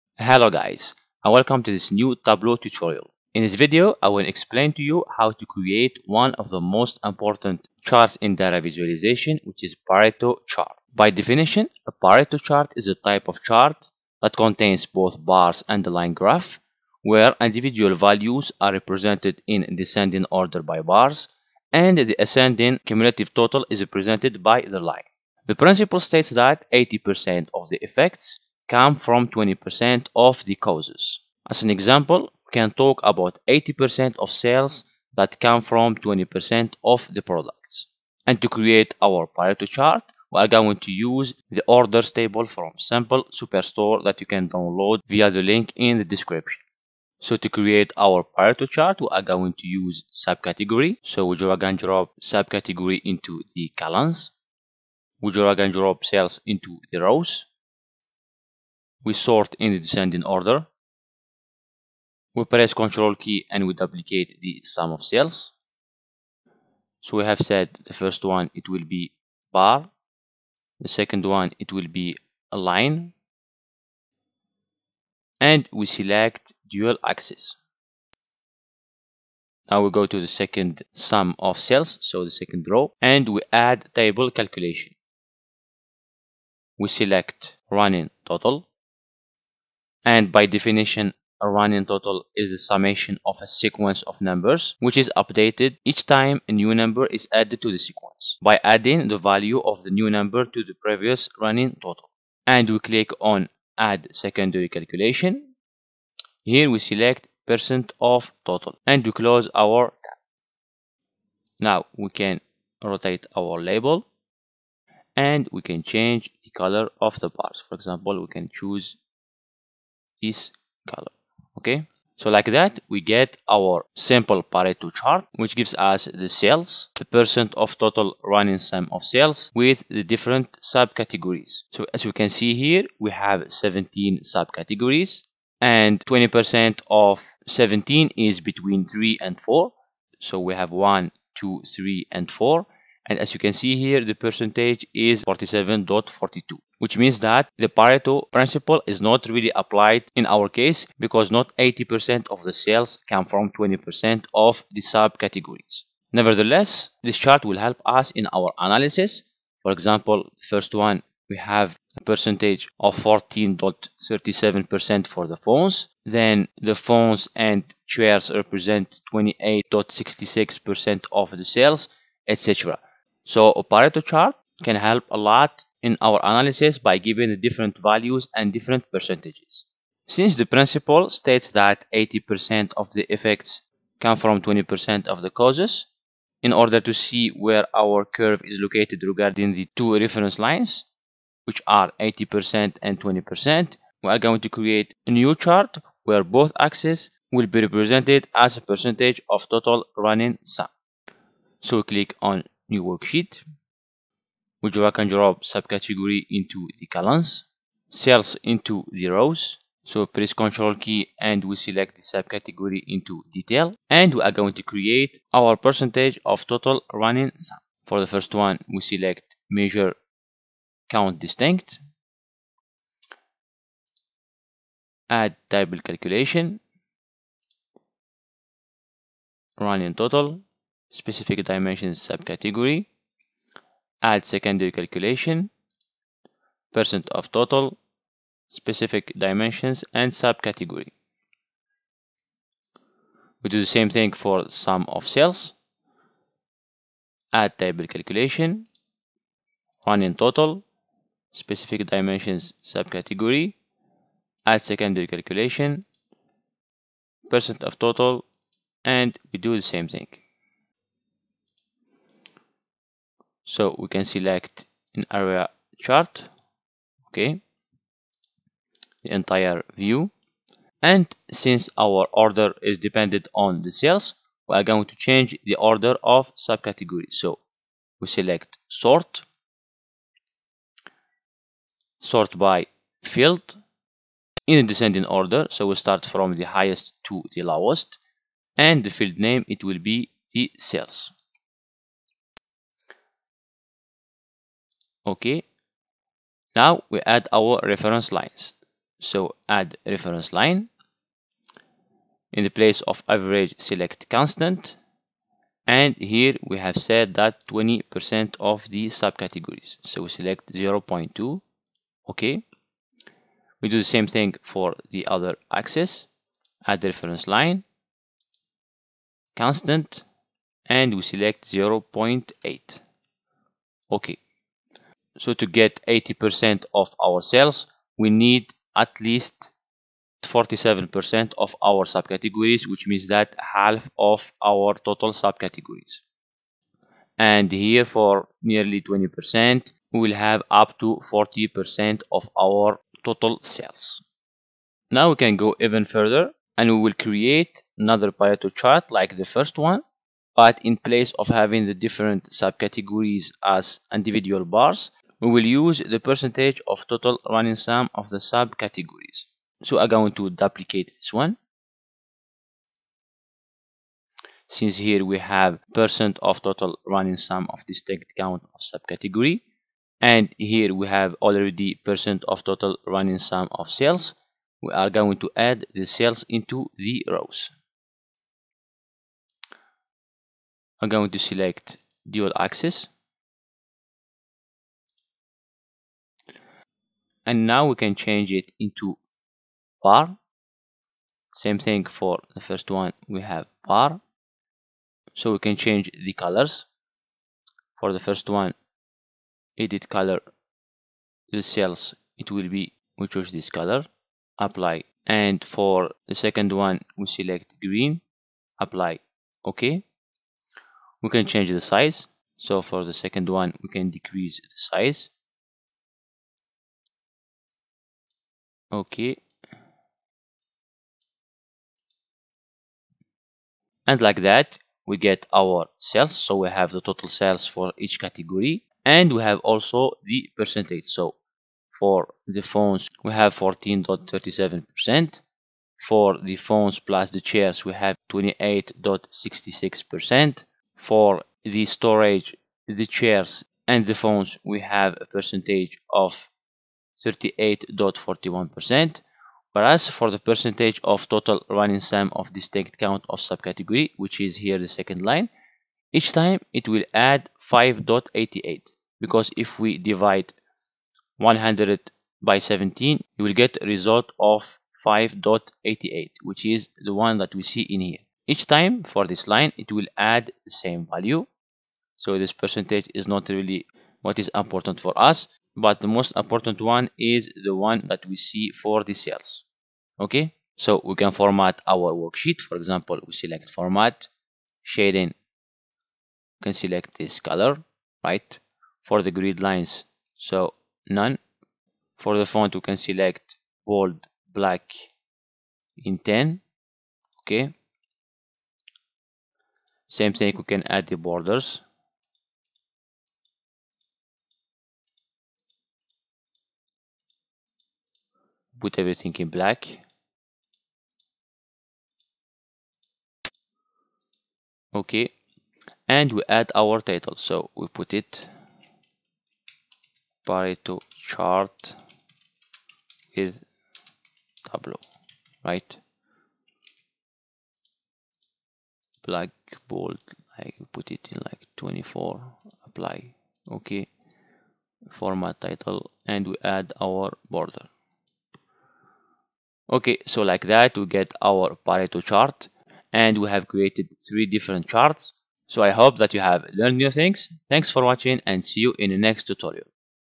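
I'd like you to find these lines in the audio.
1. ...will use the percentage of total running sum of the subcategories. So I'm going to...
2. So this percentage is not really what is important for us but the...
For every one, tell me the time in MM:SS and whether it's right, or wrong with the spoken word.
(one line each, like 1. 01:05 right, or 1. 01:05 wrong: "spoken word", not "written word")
1. 05:55 right
2. 07:51 right.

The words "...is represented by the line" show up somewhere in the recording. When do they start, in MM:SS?
00:23.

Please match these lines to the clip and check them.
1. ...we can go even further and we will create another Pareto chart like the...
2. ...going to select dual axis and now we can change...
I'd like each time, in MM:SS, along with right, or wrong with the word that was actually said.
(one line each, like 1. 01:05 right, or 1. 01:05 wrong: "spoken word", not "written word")
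1. 05:45 right
2. 06:20 right.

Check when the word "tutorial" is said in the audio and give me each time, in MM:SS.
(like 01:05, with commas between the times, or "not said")
00:02, 09:09.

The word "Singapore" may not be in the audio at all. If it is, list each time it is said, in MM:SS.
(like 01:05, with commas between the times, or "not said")
not said.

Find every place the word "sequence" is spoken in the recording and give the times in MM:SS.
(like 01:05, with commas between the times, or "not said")
01:33, 01:37.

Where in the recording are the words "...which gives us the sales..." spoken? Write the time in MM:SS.
02:05.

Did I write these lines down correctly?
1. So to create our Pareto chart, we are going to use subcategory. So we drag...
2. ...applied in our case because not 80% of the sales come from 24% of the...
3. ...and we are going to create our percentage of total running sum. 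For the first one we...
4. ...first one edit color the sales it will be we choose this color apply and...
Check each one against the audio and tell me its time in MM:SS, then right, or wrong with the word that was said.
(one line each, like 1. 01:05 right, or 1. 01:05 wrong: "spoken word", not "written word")
1. 00:47 right
2. 02:29 wrong: "20", not "24"
3. 03:33 right
4. 06:38 right.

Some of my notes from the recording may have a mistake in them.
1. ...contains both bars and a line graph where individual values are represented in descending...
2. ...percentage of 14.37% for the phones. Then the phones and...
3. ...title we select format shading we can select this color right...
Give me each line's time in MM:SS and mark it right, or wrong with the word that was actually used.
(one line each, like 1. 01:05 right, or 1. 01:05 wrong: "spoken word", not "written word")
1. 00:14 right
2. 02:42 right
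3. 08:02 wrong: "example", not "title".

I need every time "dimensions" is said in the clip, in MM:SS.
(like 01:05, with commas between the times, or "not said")
03:51, 03:59, 04:11.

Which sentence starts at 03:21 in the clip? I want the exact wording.
So click on New Worksheet Wujura can drop subcategory into the columns, sales into the rows.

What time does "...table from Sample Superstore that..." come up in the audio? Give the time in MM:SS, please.
00:42.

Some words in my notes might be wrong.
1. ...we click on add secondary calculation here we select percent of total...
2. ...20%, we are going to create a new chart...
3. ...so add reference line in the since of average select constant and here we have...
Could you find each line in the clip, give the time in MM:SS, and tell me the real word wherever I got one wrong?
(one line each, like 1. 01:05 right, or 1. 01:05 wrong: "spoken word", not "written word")
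1. 01:42 right
2. 03:12 right
3. 04:58 wrong: "place", not "since".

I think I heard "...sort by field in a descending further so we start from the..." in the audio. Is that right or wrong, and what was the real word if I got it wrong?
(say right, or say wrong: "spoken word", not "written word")
wrong: "order", not "further".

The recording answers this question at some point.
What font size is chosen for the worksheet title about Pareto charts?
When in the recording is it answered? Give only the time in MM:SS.
08:51.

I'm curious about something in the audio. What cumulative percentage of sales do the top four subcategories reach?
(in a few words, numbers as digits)
47.42%.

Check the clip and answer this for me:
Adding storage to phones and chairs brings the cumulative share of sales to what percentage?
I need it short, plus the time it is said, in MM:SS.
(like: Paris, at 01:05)
38.41%, at 07:26.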